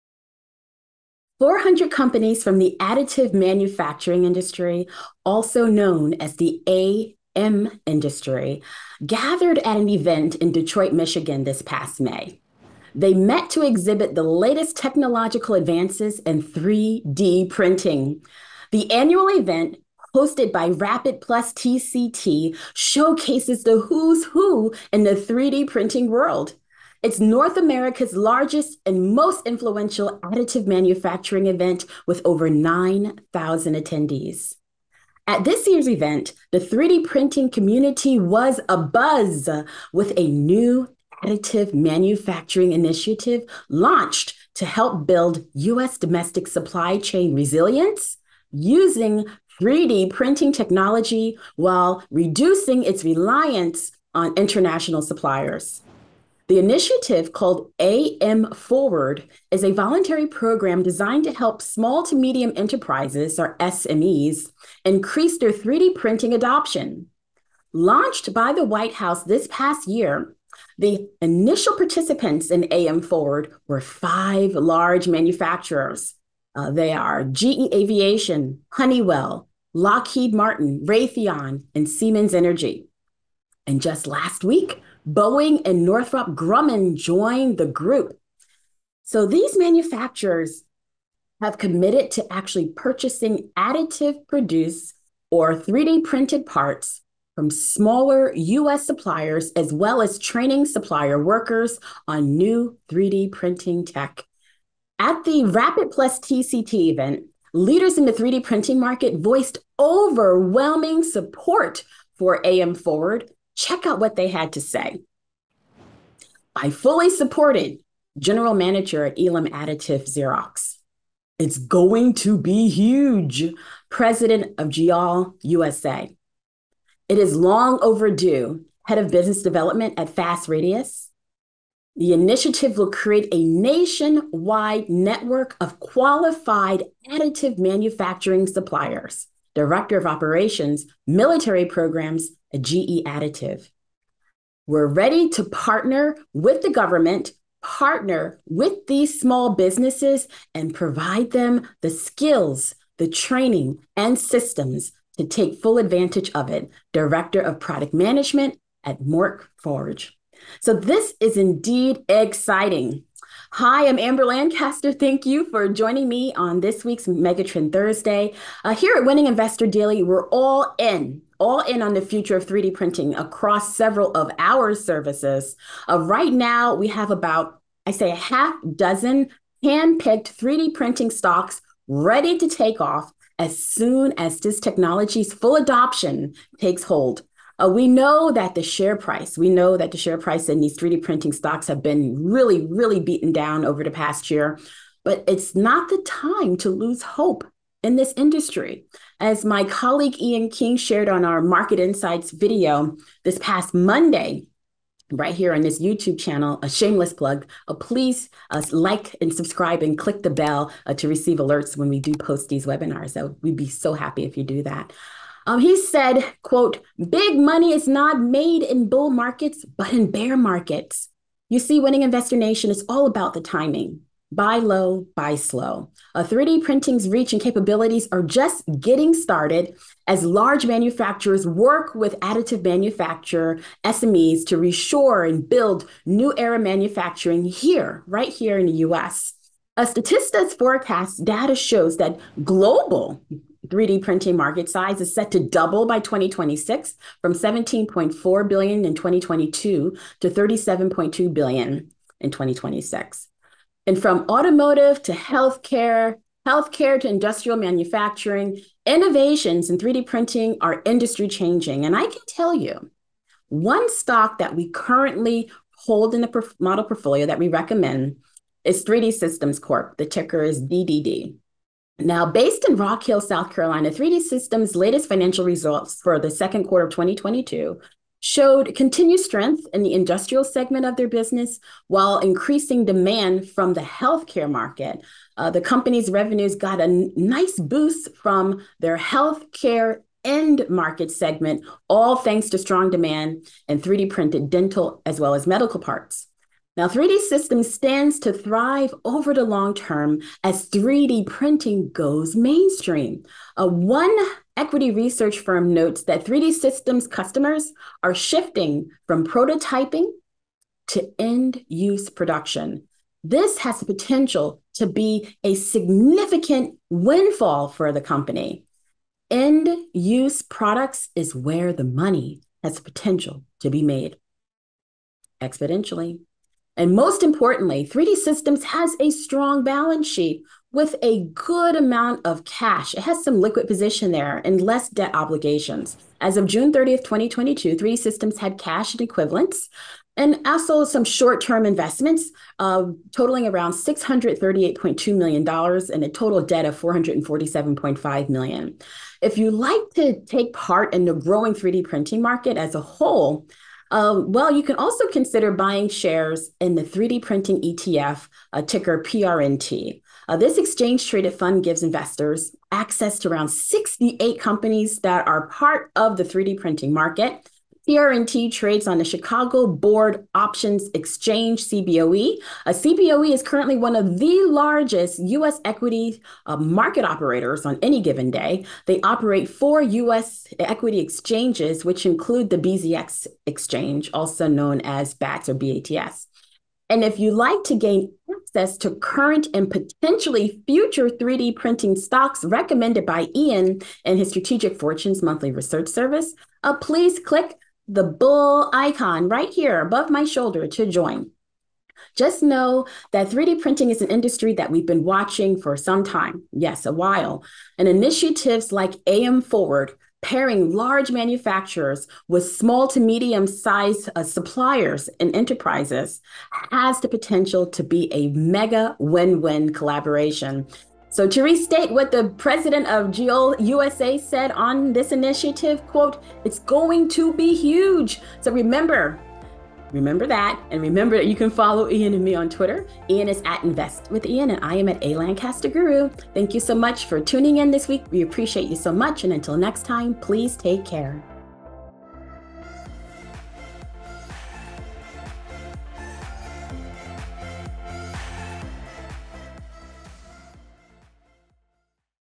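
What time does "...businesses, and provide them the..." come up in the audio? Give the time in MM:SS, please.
02:29.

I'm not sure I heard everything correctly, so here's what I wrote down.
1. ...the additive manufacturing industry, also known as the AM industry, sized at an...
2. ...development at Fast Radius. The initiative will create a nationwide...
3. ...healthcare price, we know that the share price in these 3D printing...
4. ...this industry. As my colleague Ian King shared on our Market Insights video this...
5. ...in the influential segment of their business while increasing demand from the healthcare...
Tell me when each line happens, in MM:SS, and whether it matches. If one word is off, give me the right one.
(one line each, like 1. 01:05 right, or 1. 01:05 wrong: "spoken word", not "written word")
1. 00:02 wrong: "gathered", not "sized"
2. 02:09 right
3. 03:08 wrong: "share", not "healthcare"
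4. 03:17 right
5. 04:39 wrong: "industrial", not "influential".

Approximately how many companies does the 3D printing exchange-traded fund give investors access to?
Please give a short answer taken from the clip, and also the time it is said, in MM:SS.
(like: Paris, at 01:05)
68, at 06:03.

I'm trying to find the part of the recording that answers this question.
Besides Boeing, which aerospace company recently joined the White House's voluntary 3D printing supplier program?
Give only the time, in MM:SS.
01:25.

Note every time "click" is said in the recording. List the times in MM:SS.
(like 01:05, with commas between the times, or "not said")
03:29, 06:37.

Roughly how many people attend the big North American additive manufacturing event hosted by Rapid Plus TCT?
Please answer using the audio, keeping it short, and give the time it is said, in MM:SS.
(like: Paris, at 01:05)
over 9,000, at 00:32.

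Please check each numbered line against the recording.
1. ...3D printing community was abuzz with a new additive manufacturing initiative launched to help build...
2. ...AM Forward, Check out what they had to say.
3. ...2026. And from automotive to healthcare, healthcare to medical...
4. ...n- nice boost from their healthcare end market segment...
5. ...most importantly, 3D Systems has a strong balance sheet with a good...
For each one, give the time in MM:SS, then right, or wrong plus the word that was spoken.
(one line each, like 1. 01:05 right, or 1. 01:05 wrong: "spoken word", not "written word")
1. 00:36 right
2. 01:52 right
3. 04:12 wrong: "industrial", not "medical"
4. 04:46 right
5. 05:26 right.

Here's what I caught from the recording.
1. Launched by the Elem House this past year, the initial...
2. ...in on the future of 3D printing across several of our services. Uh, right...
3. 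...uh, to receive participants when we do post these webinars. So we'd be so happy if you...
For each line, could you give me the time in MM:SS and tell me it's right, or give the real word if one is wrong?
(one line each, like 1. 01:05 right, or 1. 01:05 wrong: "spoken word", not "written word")
1. 01:07 wrong: "White", not "Elem"
2. 02:51 right
3. 03:30 wrong: "alerts", not "participants".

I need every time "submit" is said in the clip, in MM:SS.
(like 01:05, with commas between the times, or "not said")
not said.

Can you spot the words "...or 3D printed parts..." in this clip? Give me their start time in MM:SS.
01:35.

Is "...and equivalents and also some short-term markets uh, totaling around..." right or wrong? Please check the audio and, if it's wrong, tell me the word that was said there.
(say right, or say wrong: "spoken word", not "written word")
wrong: "investments", not "markets".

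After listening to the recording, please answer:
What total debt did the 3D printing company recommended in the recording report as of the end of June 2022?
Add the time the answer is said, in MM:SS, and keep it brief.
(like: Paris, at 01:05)
$447.5 million, at 05:46.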